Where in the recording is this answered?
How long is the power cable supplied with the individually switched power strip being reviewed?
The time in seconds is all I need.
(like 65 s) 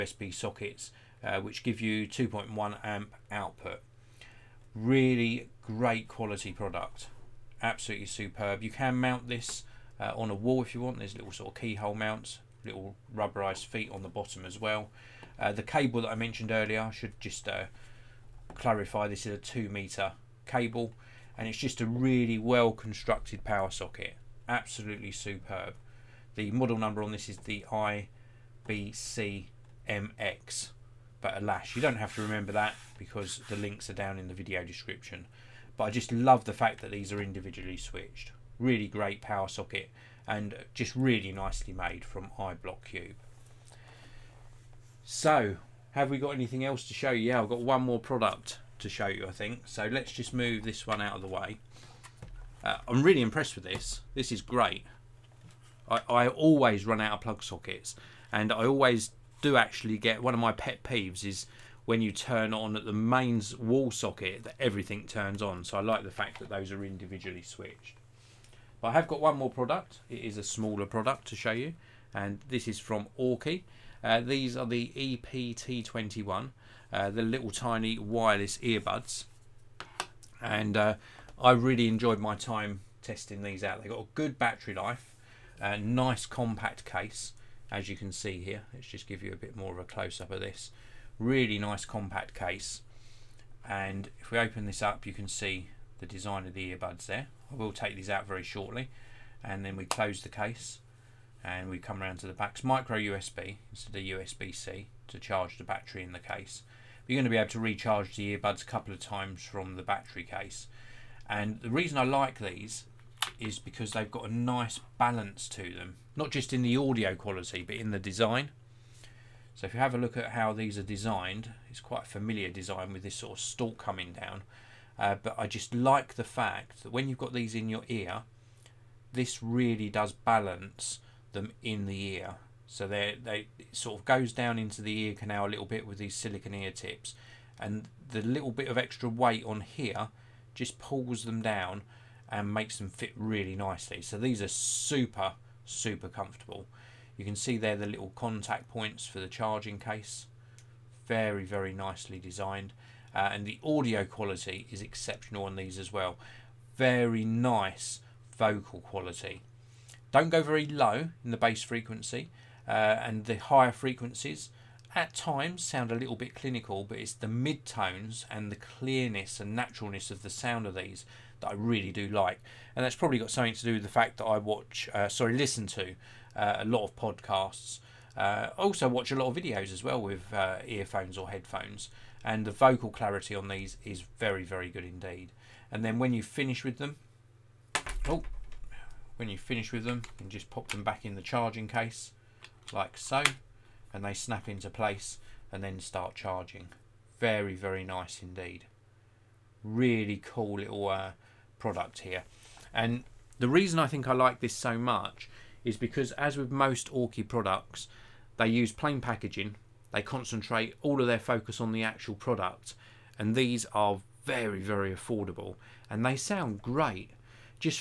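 19 s.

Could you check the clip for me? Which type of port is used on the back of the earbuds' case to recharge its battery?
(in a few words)
micro USB.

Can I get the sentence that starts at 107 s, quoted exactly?
You're going to be able to recharge the earbuds a couple of times from the battery case.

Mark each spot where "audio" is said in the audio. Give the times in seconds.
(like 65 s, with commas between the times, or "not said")
116 s, 153 s.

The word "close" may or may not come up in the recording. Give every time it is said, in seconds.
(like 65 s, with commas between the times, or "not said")
89 s, 99 s.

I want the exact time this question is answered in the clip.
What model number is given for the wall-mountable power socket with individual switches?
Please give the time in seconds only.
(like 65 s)
27 s.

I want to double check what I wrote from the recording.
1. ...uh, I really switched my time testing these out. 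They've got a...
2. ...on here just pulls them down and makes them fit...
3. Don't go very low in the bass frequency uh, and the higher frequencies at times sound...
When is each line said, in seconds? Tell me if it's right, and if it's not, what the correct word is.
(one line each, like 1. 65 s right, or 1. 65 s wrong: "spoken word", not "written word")
1. 80 s wrong: "enjoyed", not "switched"
2. 139 s right
3. 160 s right.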